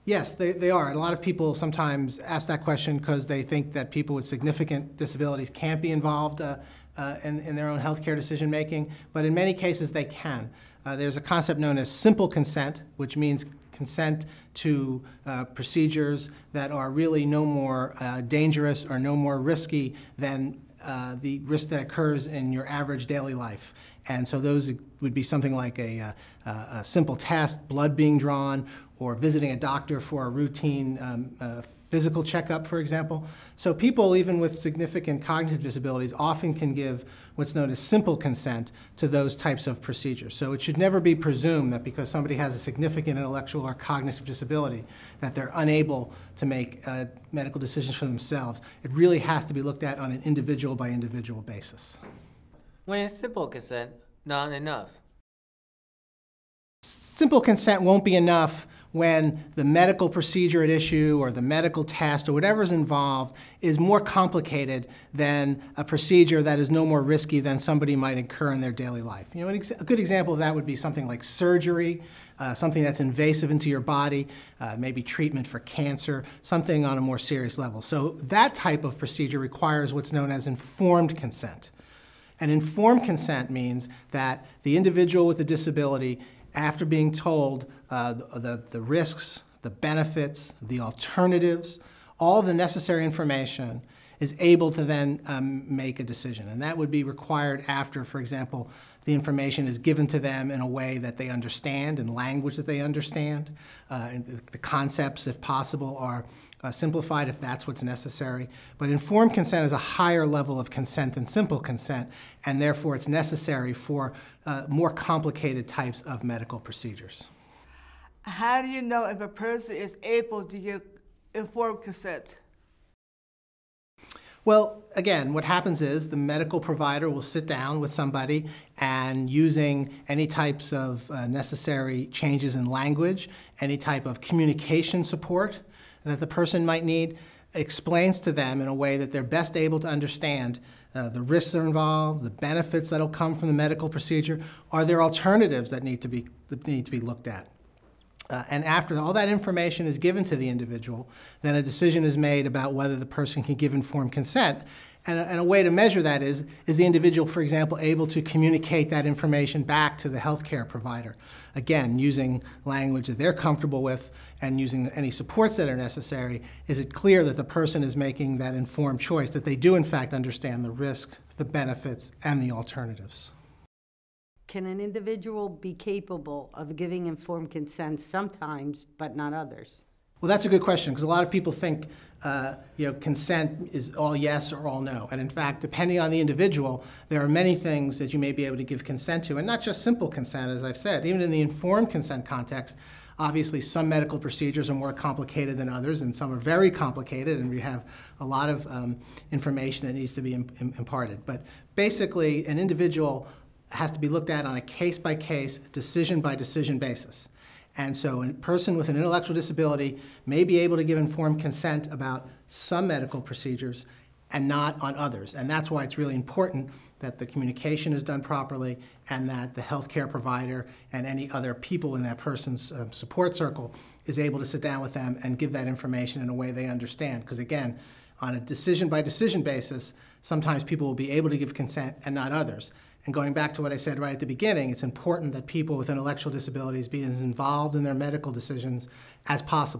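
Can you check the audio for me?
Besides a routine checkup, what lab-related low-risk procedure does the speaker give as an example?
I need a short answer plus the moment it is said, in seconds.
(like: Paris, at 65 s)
Blood being drawn, at 27 s.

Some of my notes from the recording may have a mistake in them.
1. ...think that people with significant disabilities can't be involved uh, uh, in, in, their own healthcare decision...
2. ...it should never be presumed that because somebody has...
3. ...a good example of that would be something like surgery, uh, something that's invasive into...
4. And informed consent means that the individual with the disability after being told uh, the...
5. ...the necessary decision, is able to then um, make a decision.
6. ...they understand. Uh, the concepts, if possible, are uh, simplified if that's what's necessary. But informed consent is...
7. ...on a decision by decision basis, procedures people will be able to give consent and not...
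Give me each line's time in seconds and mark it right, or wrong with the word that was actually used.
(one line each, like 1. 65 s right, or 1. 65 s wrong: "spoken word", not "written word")
1. 3 s right
2. 40 s right
3. 69 s right
4. 82 s right
5. 92 s wrong: "information", not "decision"
6. 102 s right
7. 228 s wrong: "sometimes", not "procedures".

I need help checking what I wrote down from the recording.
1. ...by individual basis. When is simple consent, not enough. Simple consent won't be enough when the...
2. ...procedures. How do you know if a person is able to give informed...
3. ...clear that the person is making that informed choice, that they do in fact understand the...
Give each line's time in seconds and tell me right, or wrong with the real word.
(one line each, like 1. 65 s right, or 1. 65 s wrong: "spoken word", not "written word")
1. 50 s right
2. 116 s right
3. 166 s right.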